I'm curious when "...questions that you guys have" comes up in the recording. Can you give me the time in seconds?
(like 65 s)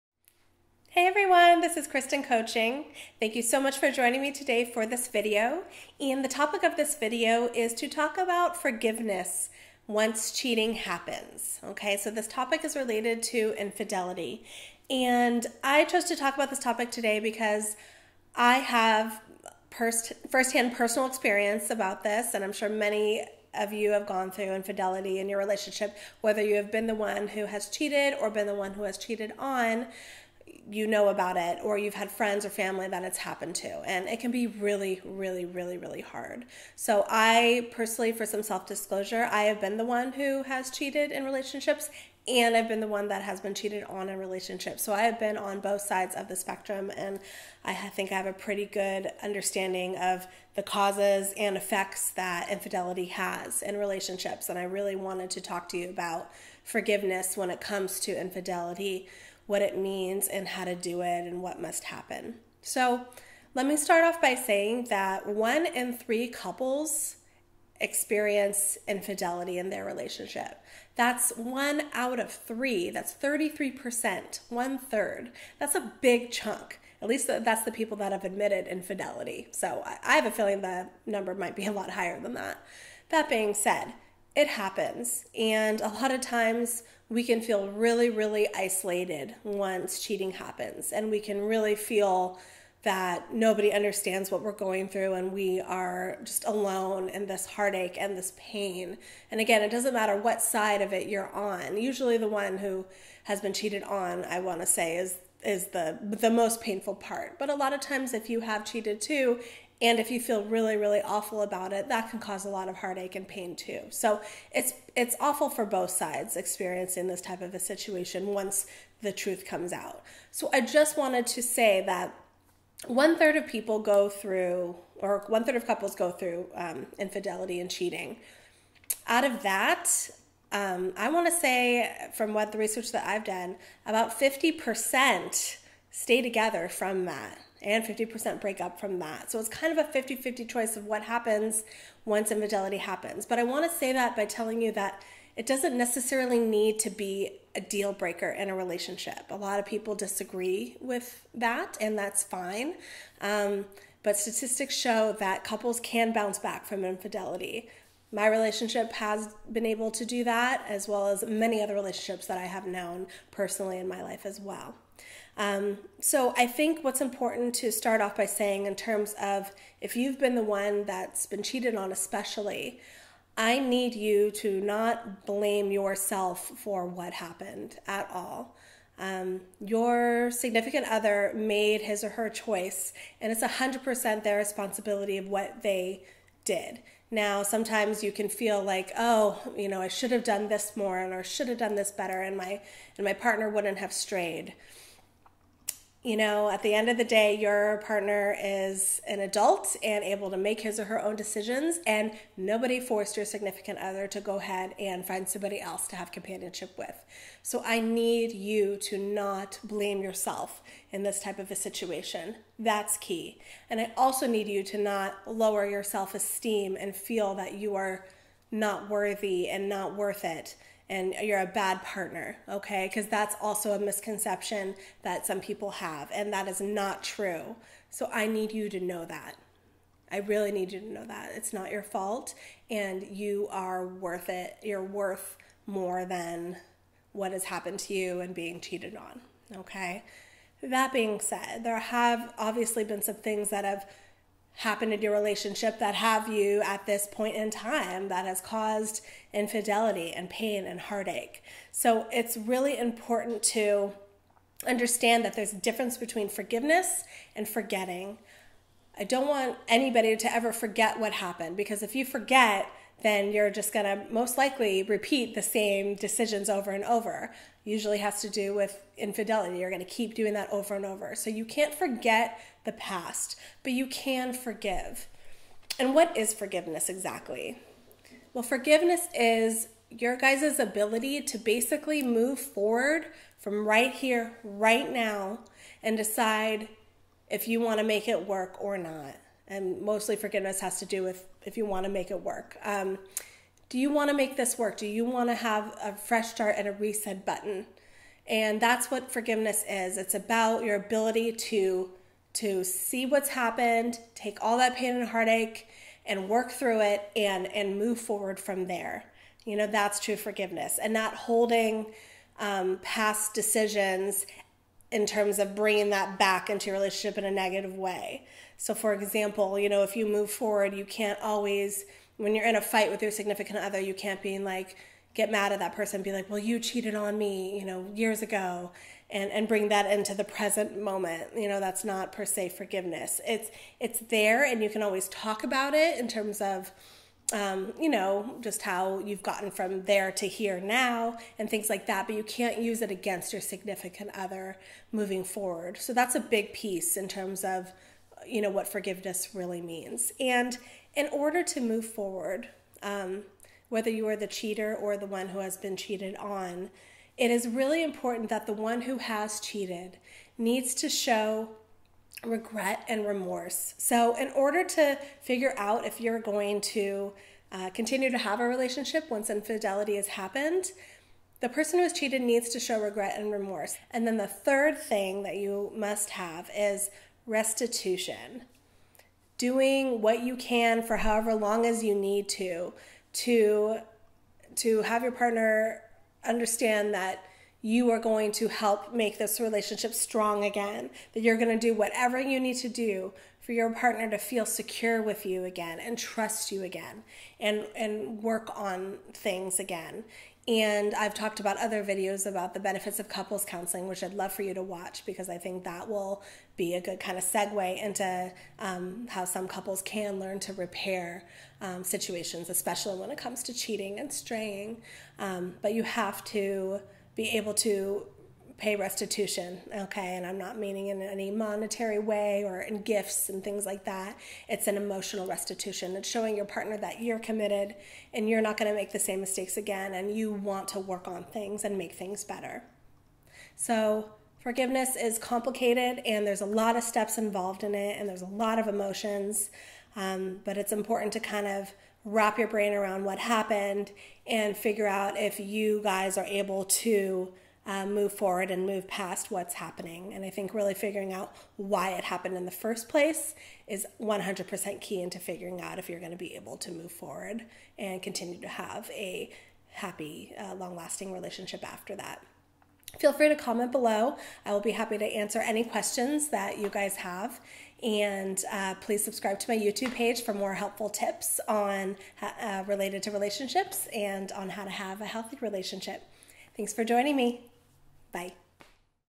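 465 s.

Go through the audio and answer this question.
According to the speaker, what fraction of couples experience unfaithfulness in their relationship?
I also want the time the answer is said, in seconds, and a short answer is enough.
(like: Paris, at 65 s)
one in three, at 65 s.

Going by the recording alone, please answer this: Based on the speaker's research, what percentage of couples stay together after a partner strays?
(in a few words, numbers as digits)
50%.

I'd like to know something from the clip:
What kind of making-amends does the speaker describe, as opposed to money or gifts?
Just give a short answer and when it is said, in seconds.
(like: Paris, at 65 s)
emotional restitution, at 424 s.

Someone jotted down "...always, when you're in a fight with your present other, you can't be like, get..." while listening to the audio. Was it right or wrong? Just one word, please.
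wrong.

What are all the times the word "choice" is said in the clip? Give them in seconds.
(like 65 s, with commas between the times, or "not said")
140 s, 182 s.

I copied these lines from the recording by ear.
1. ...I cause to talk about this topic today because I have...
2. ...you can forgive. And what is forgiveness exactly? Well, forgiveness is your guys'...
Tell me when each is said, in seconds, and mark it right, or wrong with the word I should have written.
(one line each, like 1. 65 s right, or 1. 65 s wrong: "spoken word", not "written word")
1. 15 s wrong: "chose", not "cause"
2. 273 s right.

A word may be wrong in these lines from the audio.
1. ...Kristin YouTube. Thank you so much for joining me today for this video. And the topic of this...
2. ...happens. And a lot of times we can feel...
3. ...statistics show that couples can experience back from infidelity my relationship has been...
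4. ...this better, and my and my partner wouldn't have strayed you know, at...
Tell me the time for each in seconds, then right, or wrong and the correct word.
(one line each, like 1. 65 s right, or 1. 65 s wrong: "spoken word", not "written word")
1. 1 s wrong: "Coaching", not "YouTube"
2. 84 s right
3. 154 s wrong: "bounce", not "experience"
4. 191 s right.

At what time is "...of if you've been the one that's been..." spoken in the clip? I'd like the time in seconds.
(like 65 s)
169 s.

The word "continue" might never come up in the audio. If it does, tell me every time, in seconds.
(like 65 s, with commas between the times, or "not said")
367 s, 458 s.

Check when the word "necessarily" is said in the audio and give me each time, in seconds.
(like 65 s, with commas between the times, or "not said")
145 s.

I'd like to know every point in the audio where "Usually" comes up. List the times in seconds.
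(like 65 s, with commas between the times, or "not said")
101 s, 267 s.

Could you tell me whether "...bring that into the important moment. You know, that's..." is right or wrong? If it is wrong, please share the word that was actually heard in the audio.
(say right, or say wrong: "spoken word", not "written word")
wrong: "present", not "important".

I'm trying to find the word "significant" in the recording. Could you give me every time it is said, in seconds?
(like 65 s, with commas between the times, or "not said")
180 s, 203 s, 323 s, 343 s.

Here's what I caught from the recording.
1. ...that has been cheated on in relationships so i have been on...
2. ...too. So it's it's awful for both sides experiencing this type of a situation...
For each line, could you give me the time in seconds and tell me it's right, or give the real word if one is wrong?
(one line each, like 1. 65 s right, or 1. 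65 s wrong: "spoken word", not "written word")
1. 43 s right
2. 113 s right.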